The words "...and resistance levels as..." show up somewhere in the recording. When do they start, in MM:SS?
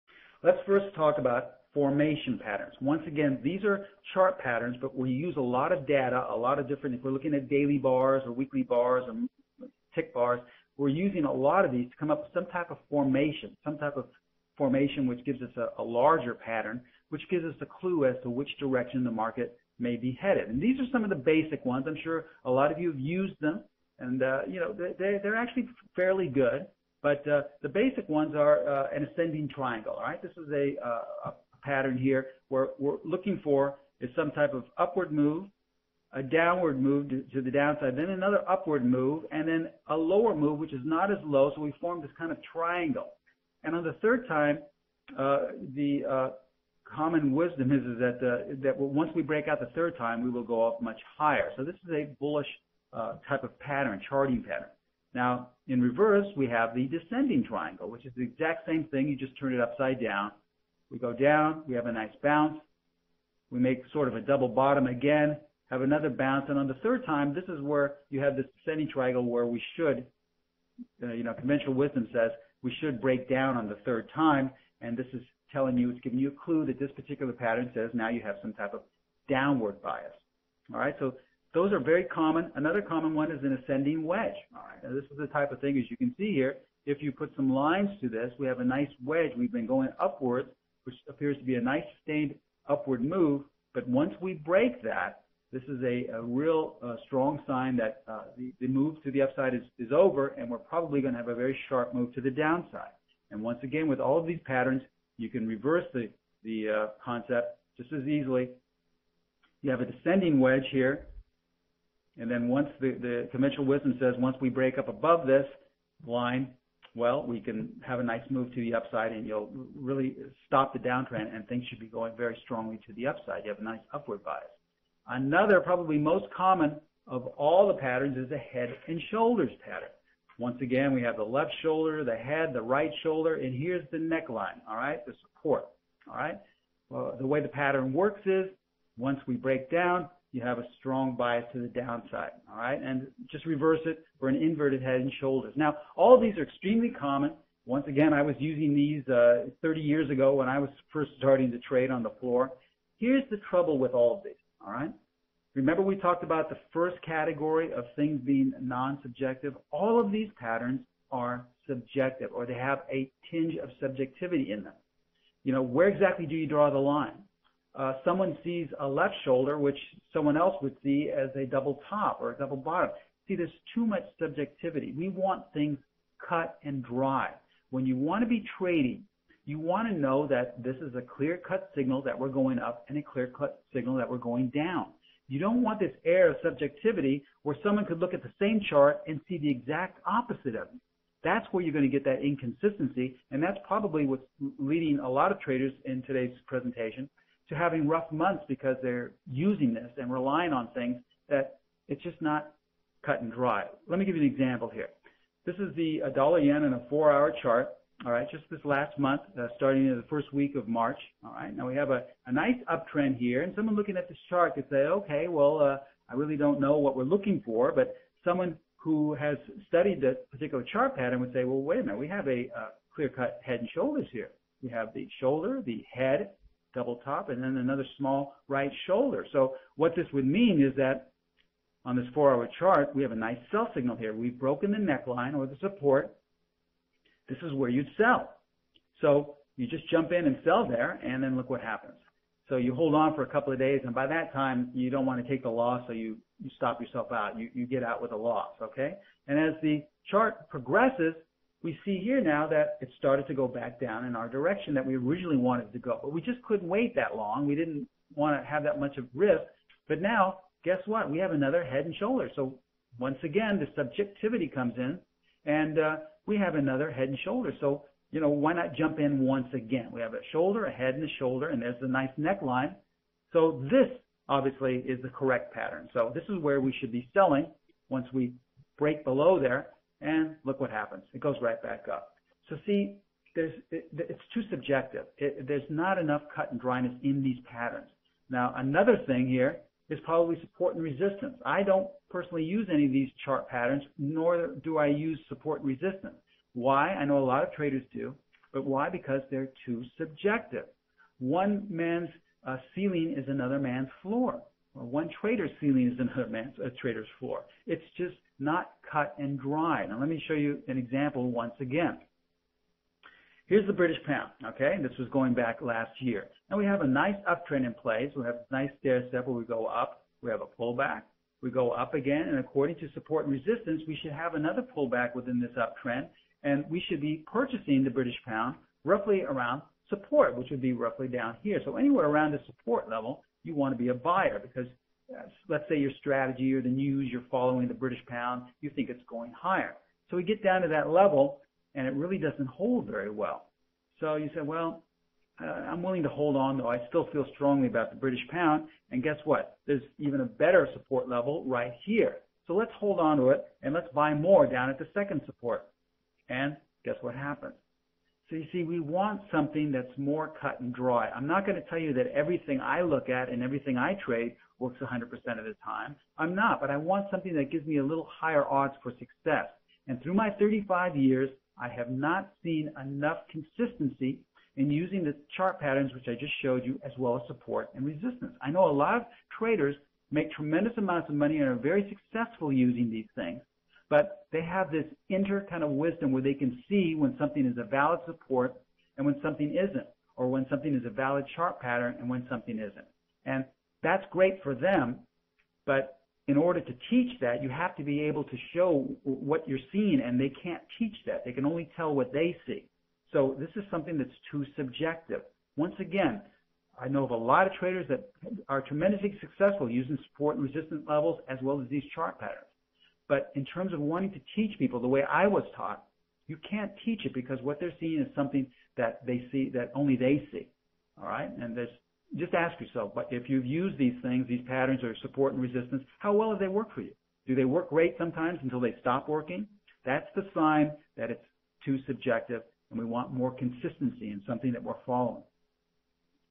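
06:50.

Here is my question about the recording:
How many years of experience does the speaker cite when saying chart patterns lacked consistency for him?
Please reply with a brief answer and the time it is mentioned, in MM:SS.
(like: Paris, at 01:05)
35 years, at 06:10.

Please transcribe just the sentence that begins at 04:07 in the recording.
You, you get out with a loss, okay?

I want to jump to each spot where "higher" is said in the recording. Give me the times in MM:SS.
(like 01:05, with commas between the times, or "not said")
00:51, 05:39, 06:08.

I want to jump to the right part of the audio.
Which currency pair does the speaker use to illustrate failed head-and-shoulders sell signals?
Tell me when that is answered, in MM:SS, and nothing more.
03:26.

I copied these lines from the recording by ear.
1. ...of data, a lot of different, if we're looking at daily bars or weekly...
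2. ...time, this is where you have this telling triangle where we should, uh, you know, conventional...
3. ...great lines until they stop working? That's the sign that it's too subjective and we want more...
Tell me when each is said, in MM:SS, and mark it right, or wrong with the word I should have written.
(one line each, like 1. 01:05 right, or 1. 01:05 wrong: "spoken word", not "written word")
1. 00:05 right
2. 01:07 wrong: "descending", not "telling"
3. 07:07 wrong: "sometimes", not "lines".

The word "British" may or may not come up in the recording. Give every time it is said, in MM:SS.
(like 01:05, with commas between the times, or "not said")
05:13, 05:27, 05:37, 05:47.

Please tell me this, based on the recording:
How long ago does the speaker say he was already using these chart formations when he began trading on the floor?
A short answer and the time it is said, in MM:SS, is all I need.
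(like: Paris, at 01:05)
30 years, at 02:29.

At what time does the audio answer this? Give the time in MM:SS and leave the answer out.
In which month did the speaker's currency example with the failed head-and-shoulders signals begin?
03:30.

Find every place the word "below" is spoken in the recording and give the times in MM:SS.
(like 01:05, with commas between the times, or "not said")
04:39.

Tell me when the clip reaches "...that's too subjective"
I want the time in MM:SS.
06:43.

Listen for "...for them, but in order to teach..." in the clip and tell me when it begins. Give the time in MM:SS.
06:34.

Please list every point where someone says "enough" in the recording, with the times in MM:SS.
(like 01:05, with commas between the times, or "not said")
04:45, 06:12.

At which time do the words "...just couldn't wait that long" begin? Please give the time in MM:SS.
04:16.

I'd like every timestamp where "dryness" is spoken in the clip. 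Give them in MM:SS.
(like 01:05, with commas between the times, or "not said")
04:46.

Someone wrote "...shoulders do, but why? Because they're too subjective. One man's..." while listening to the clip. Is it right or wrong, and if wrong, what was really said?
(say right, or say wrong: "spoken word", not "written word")
wrong: "traders", not "shoulders".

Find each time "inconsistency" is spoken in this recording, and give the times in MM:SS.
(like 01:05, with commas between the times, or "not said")
03:12.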